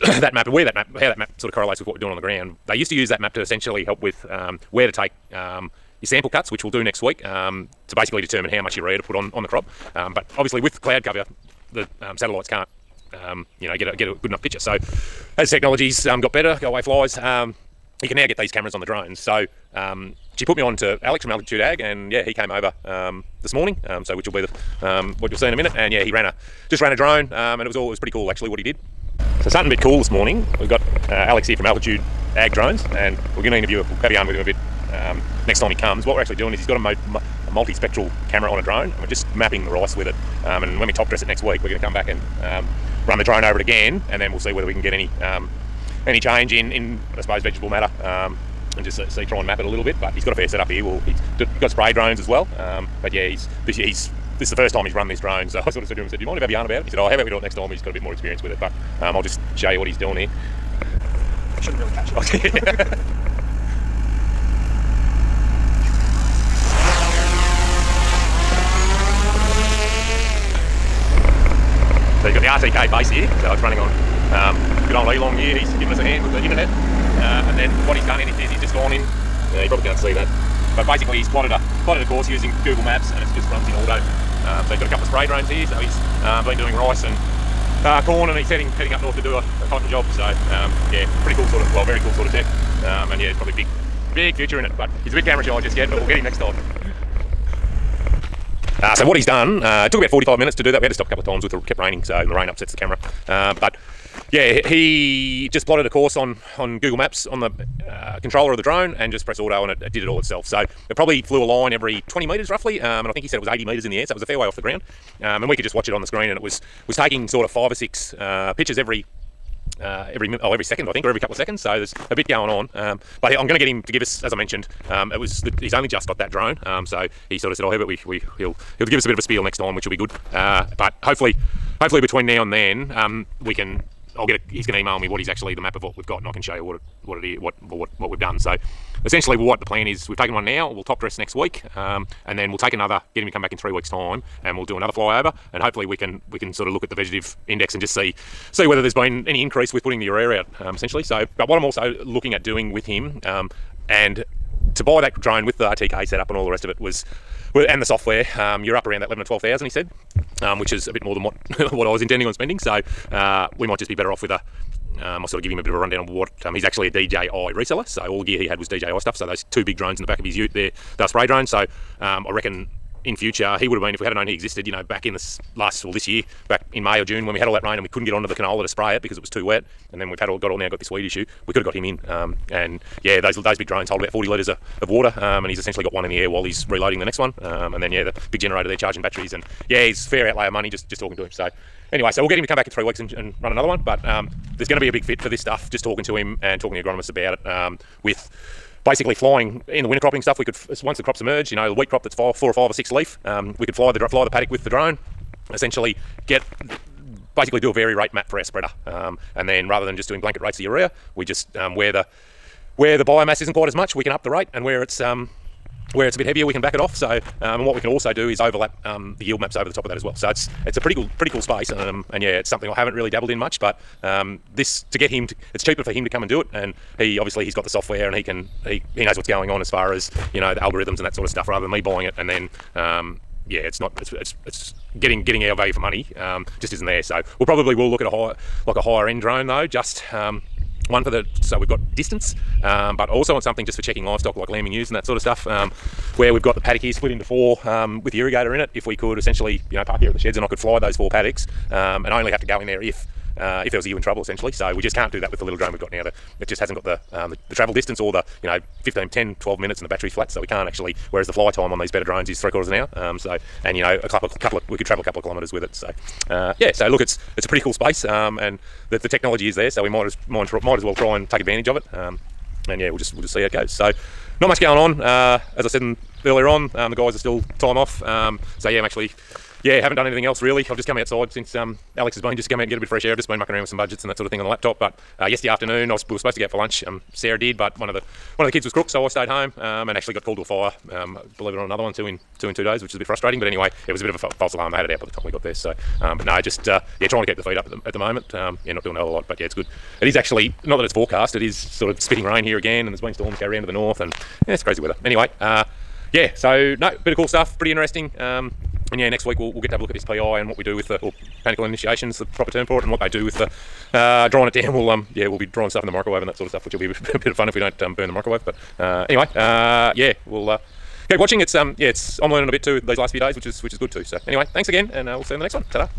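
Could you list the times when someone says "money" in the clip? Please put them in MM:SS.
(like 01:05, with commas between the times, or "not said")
03:10, 03:55.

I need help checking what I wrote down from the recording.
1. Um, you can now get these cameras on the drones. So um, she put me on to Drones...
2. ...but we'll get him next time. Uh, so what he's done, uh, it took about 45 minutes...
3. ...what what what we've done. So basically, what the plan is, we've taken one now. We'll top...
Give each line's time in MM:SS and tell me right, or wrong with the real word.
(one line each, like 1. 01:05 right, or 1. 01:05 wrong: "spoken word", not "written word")
1. 00:17 wrong: "Alex", not "Drones"
2. 01:35 right
3. 02:17 wrong: "essentially", not "basically".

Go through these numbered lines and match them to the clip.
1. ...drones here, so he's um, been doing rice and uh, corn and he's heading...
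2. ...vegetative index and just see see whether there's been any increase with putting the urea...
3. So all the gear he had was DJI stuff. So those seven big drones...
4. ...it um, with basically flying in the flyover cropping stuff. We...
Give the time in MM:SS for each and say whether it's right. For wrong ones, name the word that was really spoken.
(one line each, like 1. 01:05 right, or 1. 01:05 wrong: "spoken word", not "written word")
1. 01:25 right
2. 02:26 right
3. 02:47 wrong: "two", not "seven"
4. 03:17 wrong: "winter", not "flyover".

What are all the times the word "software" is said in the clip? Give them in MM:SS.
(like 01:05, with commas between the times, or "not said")
02:37, 03:47.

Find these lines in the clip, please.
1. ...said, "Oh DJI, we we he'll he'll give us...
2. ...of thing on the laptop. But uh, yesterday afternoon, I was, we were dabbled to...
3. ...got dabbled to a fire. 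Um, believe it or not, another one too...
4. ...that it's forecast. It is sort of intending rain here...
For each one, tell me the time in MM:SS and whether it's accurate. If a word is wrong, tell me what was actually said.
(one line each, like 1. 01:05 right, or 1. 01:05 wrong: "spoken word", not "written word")
1. 02:07 wrong: "Herbert", not "DJI"
2. 04:44 wrong: "supposed", not "dabbled"
3. 04:50 wrong: "called", not "dabbled"
4. 05:00 wrong: "spitting", not "intending".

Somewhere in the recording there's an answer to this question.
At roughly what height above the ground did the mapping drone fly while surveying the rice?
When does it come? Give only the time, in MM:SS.
01:53.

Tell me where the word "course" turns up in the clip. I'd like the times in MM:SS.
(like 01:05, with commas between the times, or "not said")
01:22, 01:45.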